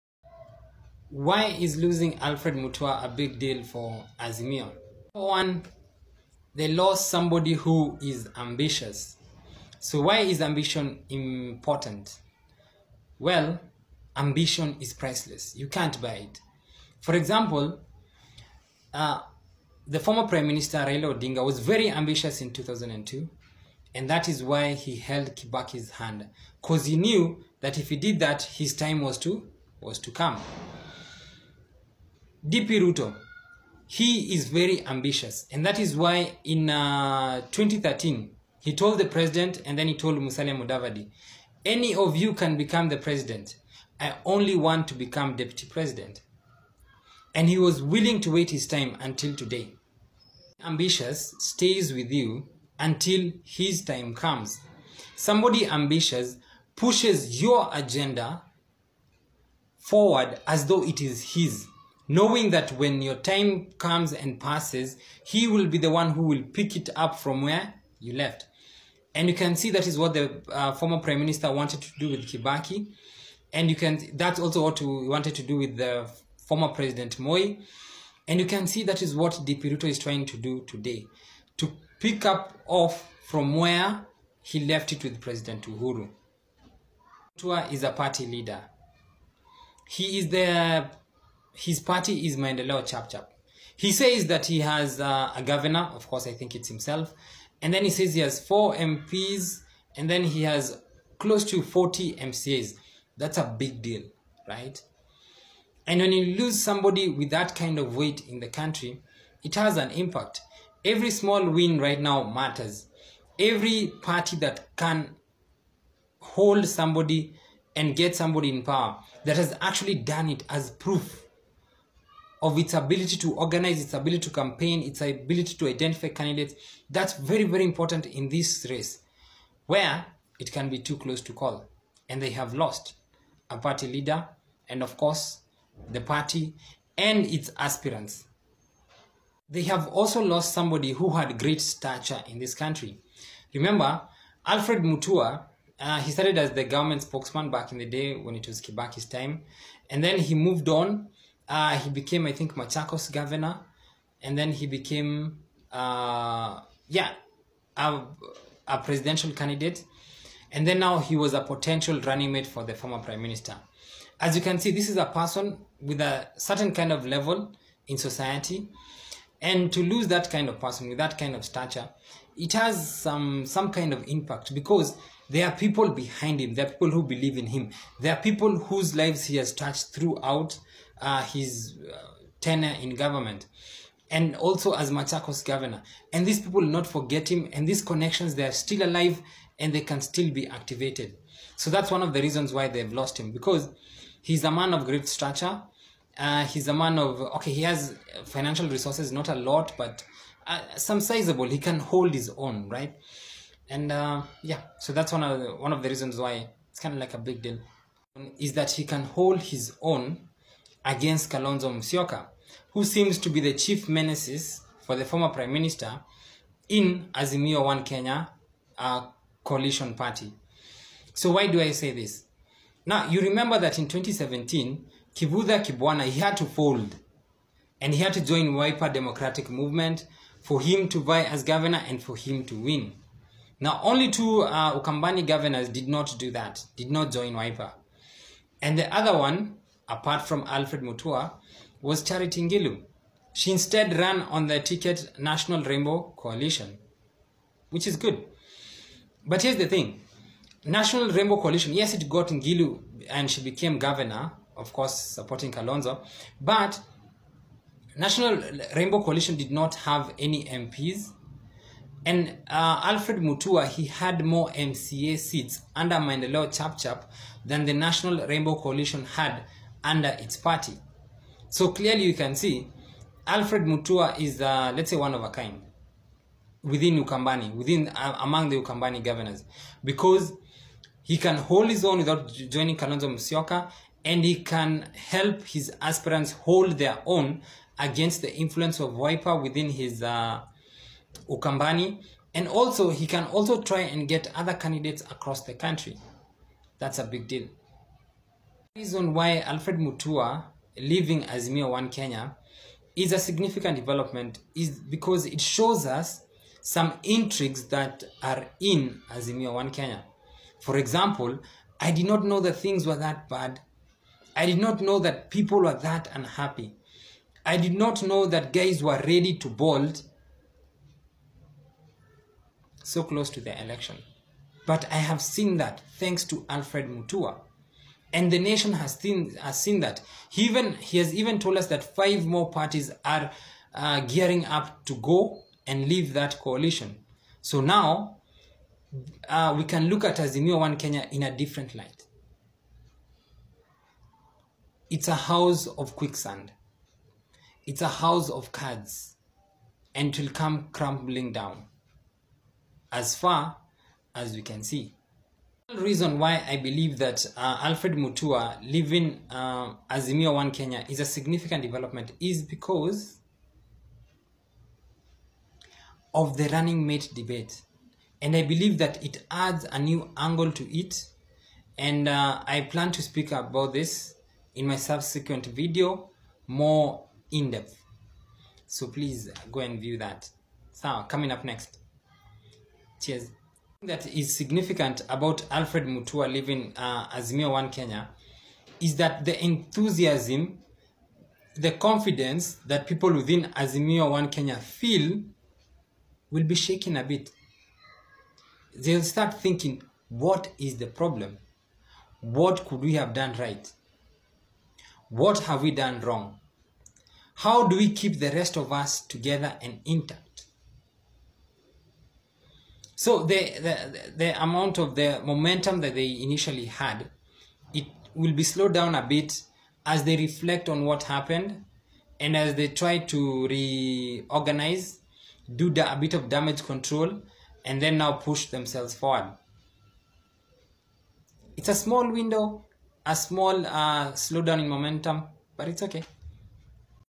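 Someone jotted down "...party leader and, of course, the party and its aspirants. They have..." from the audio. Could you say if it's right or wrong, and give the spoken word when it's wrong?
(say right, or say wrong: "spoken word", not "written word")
right.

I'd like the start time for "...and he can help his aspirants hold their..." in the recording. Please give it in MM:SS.
04:44.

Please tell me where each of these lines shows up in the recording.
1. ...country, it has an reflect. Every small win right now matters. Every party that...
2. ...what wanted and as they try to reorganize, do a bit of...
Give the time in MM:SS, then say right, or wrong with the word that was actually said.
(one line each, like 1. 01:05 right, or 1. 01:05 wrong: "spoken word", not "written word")
1. 01:48 wrong: "impact", not "reflect"
2. 07:00 wrong: "happened", not "wanted".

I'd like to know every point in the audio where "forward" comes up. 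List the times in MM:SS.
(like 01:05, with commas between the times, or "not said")
00:59, 07:08.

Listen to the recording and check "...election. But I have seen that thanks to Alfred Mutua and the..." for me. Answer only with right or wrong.
right.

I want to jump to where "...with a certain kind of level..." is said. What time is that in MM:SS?
02:45.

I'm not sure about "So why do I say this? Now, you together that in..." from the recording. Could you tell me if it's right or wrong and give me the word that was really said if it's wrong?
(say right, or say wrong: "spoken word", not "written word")
wrong: "remember", not "together".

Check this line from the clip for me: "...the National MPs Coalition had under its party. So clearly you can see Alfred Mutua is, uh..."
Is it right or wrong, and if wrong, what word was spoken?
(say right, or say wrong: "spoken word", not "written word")
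wrong: "Rainbow", not "MPs".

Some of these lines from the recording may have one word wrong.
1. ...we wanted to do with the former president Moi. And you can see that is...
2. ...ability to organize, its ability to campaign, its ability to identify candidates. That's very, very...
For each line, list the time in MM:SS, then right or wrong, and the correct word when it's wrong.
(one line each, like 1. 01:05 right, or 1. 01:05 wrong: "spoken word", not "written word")
1. 01:14 right
2. 02:02 right.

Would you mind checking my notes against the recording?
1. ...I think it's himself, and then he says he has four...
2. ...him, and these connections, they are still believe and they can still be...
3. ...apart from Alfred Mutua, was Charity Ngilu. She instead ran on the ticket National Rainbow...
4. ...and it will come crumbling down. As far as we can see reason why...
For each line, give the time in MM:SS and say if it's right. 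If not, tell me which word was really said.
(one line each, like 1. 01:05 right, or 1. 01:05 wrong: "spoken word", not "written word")
1. 01:36 right
2. 03:07 wrong: "alive", not "believe"
3. 03:59 right
4. 05:49 right.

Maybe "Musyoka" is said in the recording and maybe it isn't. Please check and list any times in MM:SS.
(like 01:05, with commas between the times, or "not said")
03:31, 04:43.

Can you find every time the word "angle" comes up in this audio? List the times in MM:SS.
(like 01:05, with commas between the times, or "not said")
06:10.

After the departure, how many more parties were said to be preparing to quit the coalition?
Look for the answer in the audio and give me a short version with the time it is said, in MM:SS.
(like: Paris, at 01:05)
5, at 05:31.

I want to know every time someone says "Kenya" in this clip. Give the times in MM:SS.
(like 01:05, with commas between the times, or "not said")
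03:37, 05:01, 05:09, 05:40, 06:00, 06:27, 06:34.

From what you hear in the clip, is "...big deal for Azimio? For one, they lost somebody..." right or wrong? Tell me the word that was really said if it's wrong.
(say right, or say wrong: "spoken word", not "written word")
right.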